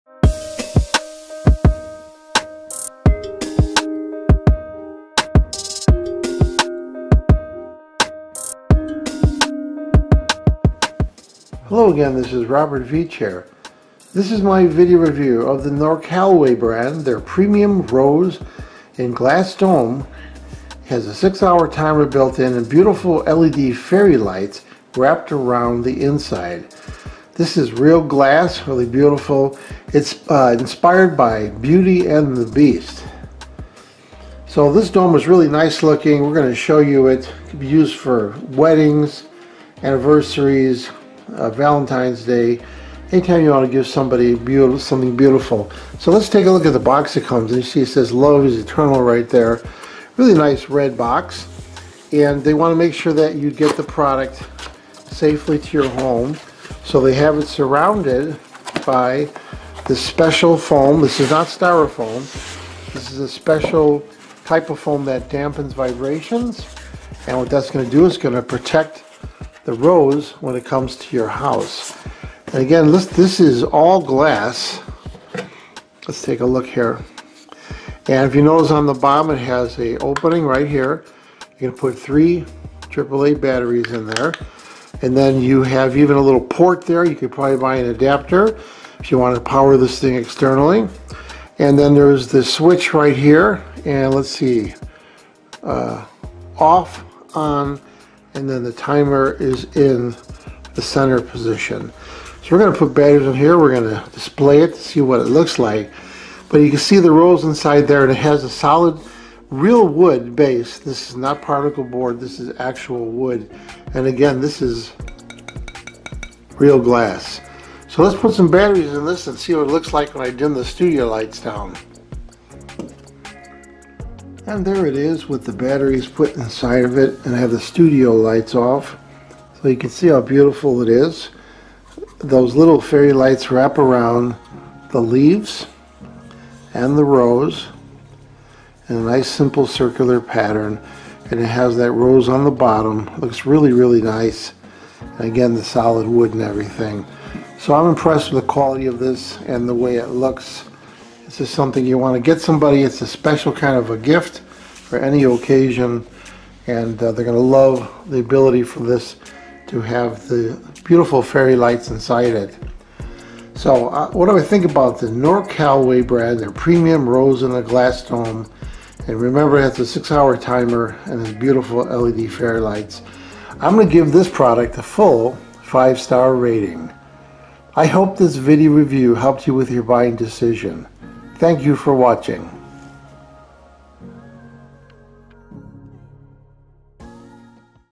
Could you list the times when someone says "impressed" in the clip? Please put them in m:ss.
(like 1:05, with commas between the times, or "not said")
2:27.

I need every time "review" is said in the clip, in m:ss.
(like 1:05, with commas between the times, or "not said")
0:14, 2:58.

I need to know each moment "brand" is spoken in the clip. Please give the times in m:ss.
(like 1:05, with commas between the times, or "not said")
0:16, 2:46.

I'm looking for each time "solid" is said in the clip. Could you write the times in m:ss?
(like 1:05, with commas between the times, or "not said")
1:48, 2:25.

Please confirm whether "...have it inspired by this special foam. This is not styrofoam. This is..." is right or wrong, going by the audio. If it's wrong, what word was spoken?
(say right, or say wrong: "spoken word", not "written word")
wrong: "surrounded", not "inspired".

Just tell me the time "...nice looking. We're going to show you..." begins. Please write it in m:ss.
0:35.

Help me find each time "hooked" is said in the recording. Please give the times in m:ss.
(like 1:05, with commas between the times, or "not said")
not said.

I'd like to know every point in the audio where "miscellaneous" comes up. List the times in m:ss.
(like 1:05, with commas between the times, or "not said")
not said.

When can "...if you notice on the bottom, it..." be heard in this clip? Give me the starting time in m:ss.
1:18.